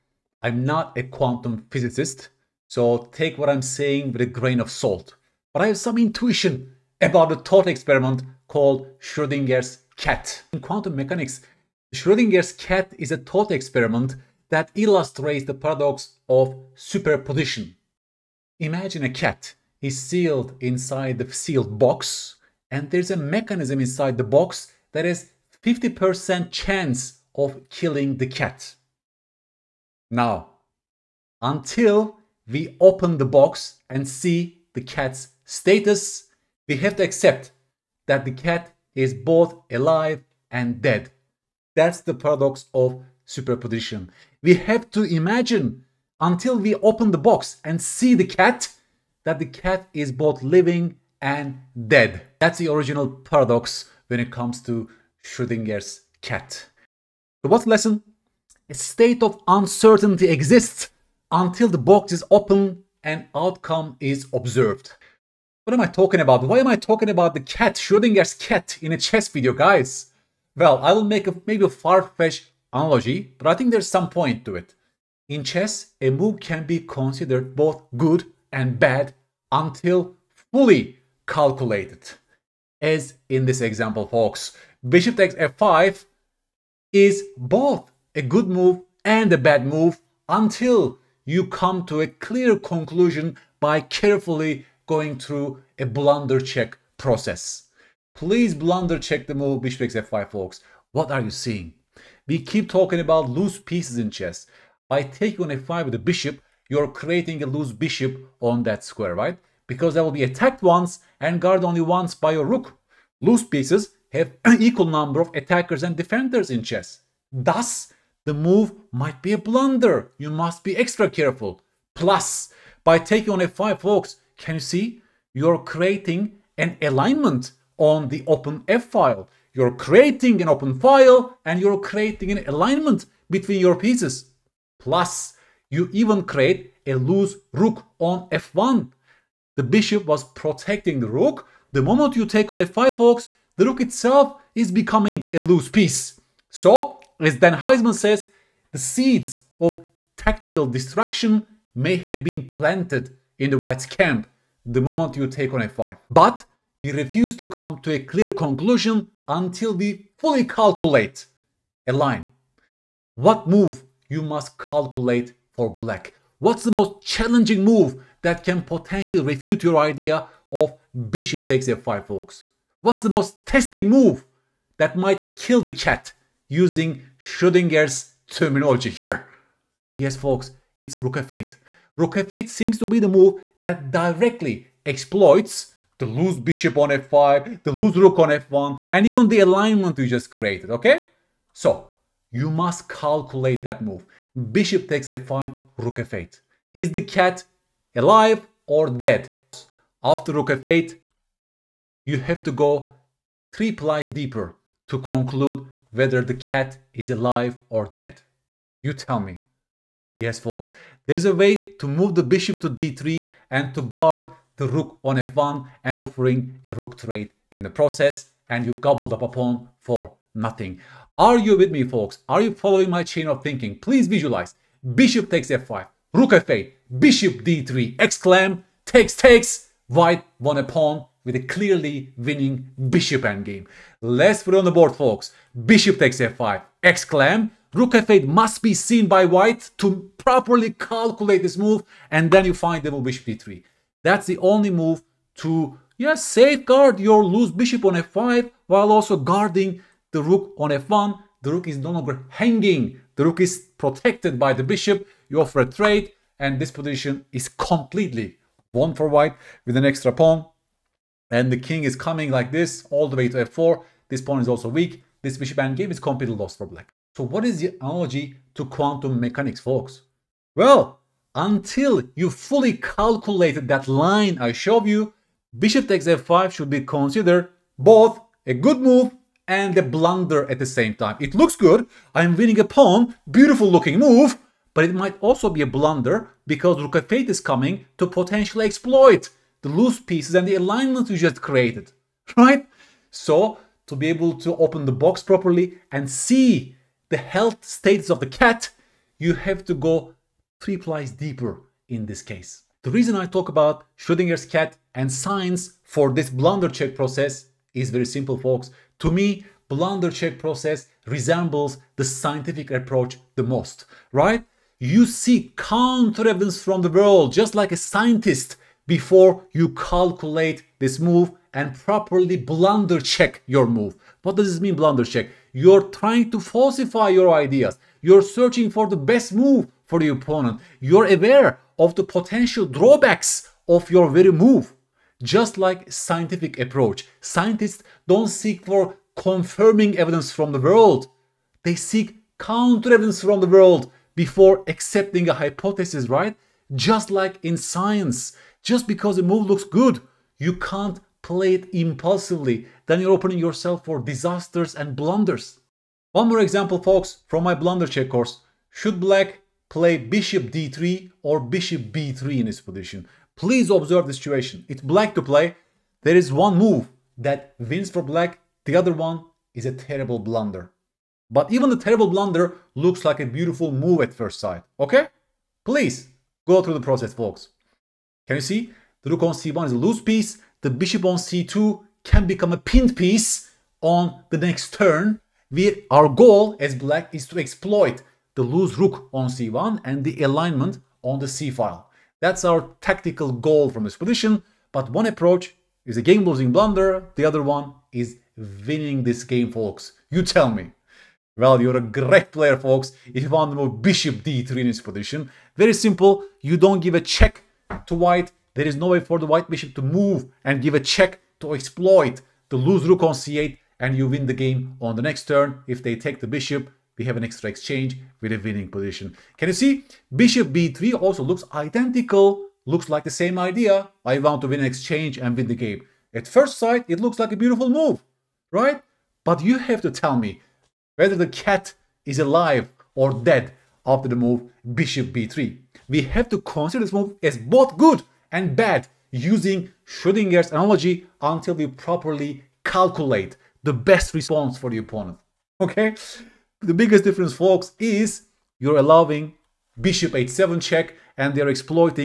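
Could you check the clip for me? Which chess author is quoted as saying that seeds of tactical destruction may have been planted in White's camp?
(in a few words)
Dan Heisman.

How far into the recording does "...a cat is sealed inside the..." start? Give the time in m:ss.
0:19.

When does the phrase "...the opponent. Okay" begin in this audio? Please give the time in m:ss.
7:24.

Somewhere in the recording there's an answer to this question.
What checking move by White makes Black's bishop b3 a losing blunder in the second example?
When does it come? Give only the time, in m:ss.
7:29.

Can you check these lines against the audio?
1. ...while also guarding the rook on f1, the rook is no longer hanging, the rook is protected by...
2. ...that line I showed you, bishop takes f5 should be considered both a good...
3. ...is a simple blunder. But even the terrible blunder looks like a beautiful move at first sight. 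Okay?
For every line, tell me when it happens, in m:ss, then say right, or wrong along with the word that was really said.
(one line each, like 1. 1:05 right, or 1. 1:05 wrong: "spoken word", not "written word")
1. 4:08 right
2. 4:33 right
3. 6:09 wrong: "terrible", not "simple".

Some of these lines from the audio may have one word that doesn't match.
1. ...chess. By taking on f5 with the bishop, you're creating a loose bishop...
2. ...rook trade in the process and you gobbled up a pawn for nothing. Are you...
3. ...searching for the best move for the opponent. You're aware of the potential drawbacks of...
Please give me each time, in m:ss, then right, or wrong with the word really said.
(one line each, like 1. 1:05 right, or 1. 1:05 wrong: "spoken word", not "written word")
1. 1:44 right
2. 3:36 right
3. 5:28 right.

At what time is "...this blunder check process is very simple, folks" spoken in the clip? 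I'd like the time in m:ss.
5:06.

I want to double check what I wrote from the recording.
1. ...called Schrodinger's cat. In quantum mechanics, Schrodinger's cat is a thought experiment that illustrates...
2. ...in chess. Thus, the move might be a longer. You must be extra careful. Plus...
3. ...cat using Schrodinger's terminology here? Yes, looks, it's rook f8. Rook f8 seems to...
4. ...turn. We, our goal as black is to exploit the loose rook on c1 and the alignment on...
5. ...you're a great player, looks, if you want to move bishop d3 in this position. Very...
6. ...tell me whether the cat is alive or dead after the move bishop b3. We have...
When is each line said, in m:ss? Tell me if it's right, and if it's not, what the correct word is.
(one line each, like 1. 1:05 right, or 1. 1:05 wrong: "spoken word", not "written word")
1. 0:08 right
2. 1:56 wrong: "blunder", not "longer"
3. 2:55 wrong: "folks", not "looks"
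4. 6:24 right
5. 6:41 wrong: "folks", not "looks"
6. 7:09 right.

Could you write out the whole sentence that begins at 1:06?
Why am I talking about the cat, Schrodinger's cat, in a chess video, guys?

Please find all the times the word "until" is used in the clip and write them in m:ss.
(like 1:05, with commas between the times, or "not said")
0:31, 0:46, 1:01, 1:19, 1:30, 2:39, 4:31, 7:21.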